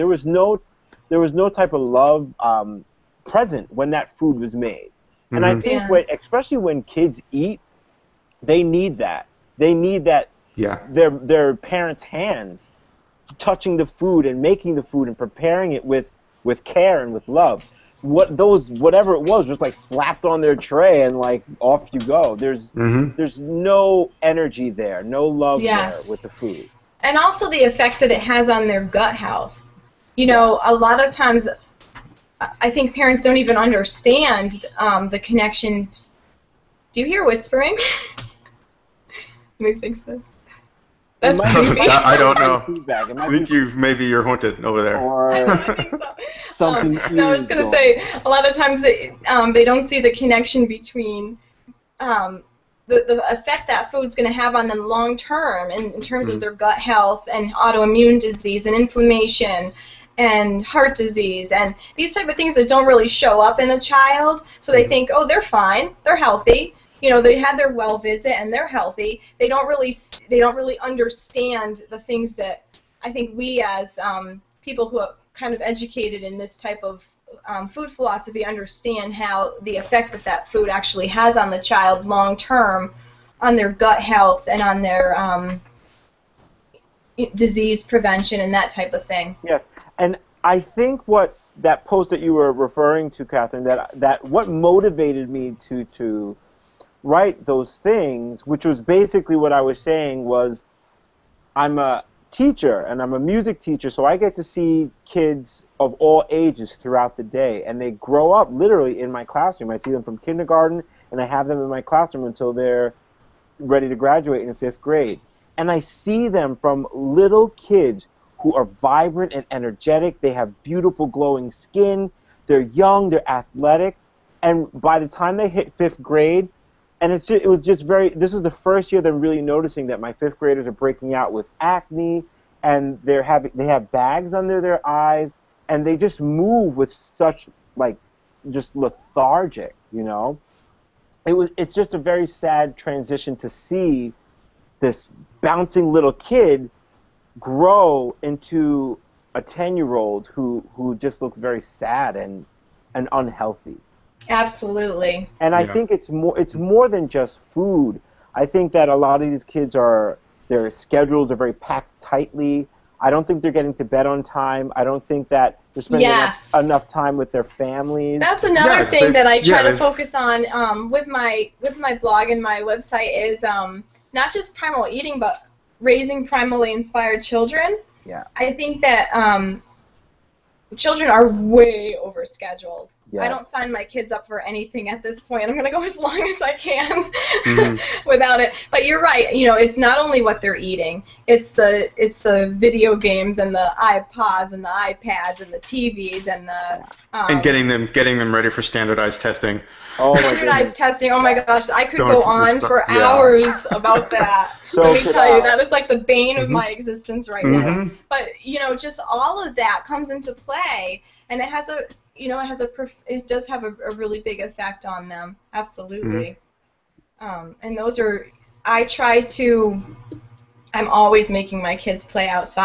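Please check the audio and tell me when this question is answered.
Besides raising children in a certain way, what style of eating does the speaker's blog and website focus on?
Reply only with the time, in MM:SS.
02:54.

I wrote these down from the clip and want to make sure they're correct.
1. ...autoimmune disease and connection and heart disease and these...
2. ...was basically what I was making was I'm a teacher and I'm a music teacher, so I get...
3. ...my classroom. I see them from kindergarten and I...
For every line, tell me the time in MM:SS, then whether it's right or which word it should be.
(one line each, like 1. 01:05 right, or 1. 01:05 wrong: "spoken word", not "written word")
1. 00:57 wrong: "inflammation", not "connection"
2. 01:38 wrong: "saying", not "making"
3. 01:49 right.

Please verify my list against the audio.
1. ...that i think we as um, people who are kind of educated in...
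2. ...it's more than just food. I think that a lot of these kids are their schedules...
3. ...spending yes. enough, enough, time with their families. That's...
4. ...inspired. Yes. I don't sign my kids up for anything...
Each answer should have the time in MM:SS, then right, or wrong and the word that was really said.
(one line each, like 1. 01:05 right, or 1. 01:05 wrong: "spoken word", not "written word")
1. 01:12 right
2. 02:36 right
3. 02:45 right
4. 03:02 wrong: "scheduled", not "inspired".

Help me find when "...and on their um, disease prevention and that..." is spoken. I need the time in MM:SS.
01:24.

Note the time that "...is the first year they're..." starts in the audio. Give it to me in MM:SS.
02:08.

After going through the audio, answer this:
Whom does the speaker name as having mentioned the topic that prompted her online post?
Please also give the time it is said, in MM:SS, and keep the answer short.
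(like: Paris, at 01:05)
Kathryn, at 01:33.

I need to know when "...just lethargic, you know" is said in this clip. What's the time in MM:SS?
02:18.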